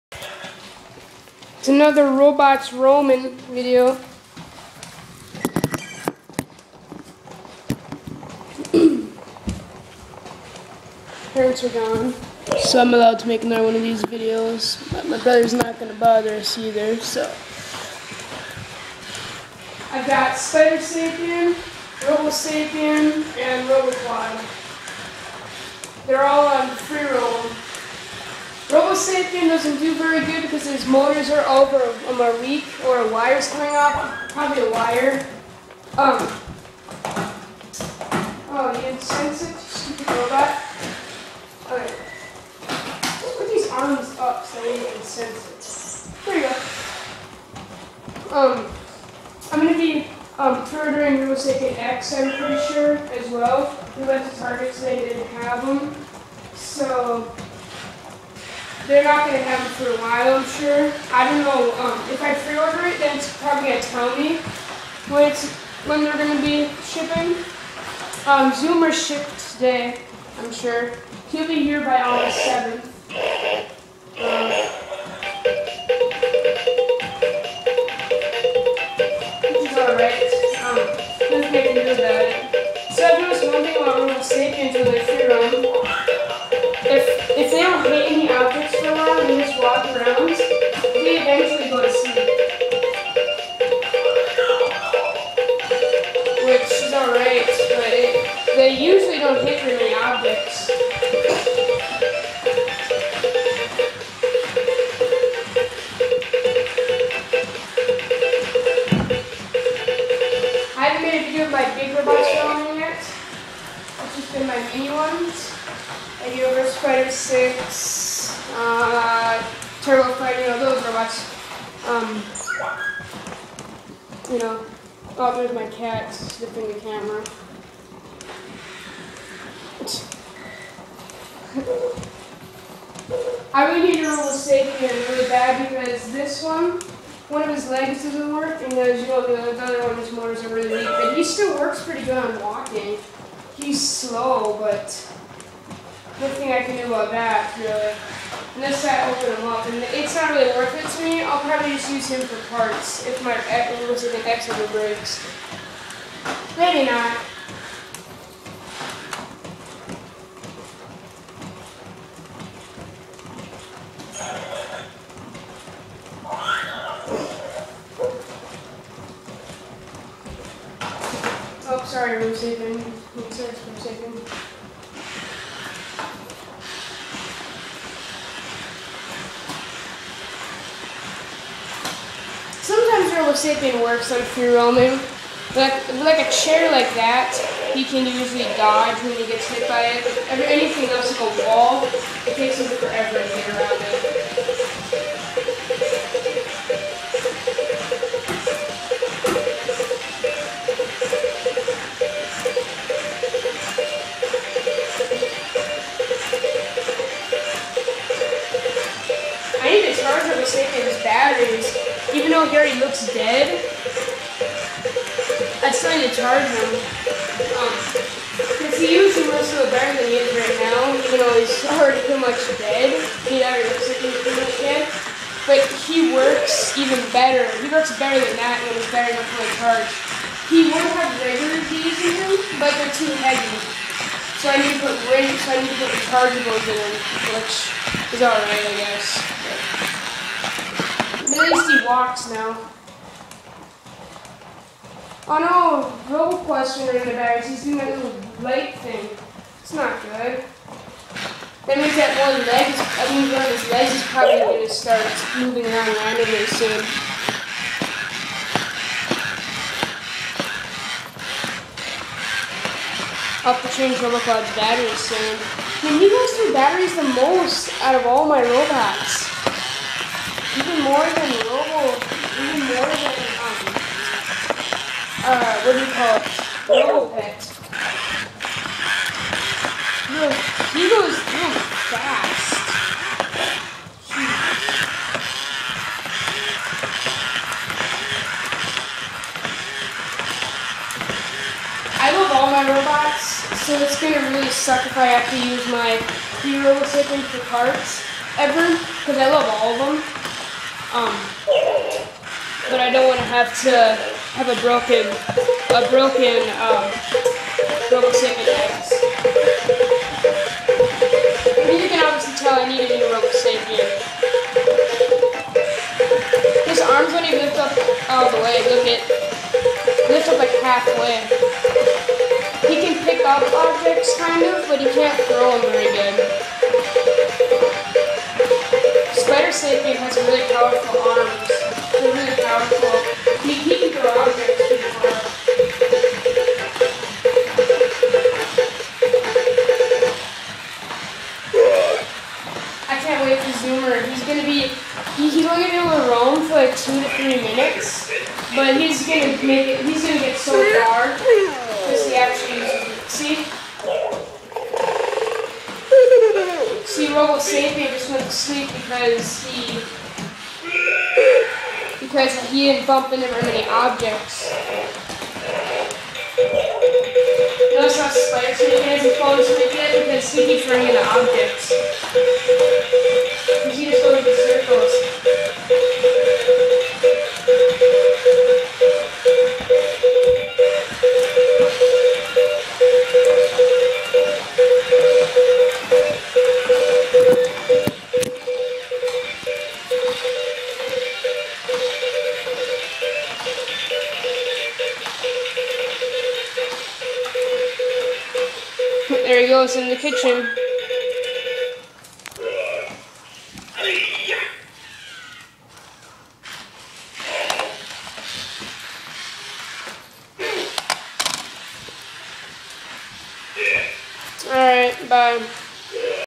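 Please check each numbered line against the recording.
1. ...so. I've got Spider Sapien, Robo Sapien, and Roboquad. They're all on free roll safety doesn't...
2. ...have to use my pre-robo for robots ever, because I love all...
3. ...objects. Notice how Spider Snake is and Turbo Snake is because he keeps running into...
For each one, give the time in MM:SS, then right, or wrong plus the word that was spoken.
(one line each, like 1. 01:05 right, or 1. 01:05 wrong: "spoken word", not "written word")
1. 00:16 right
2. 04:55 wrong: "parts", not "robots"
3. 06:03 wrong: "Fallen", not "Turbo".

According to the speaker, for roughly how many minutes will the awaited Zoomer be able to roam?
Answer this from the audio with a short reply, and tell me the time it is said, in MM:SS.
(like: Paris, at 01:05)
2 to 3 minutes, at 05:46.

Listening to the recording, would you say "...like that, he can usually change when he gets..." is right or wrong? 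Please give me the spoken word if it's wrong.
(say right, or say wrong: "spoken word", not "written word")
wrong: "dodge", not "change".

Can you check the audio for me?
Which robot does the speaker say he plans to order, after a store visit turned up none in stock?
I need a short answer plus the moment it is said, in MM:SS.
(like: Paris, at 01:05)
Robosapien X, at 00:51.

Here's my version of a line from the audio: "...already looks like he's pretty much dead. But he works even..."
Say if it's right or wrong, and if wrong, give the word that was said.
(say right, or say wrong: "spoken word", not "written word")
right.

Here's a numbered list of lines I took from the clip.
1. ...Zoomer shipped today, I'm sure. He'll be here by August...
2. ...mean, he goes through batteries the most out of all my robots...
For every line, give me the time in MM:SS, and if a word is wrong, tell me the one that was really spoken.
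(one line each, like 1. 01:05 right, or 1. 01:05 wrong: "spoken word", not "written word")
1. 01:08 right
2. 04:25 right.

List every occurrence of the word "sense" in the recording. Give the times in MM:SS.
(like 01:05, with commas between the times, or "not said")
00:39, 00:45.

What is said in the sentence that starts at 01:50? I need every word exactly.
I haven't made a video of my big robots filming yet.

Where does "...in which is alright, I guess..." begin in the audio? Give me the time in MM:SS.
03:56.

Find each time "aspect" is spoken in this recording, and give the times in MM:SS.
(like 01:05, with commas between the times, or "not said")
not said.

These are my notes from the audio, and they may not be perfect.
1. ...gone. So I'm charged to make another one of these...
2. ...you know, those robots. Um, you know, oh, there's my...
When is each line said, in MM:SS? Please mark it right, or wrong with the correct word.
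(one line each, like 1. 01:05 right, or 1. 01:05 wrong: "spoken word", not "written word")
1. 00:11 wrong: "allowed", not "charged"
2. 02:00 right.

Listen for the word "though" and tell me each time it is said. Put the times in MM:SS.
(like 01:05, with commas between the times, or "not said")
03:32, 03:41.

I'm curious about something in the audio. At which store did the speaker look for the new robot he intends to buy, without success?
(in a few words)
Target.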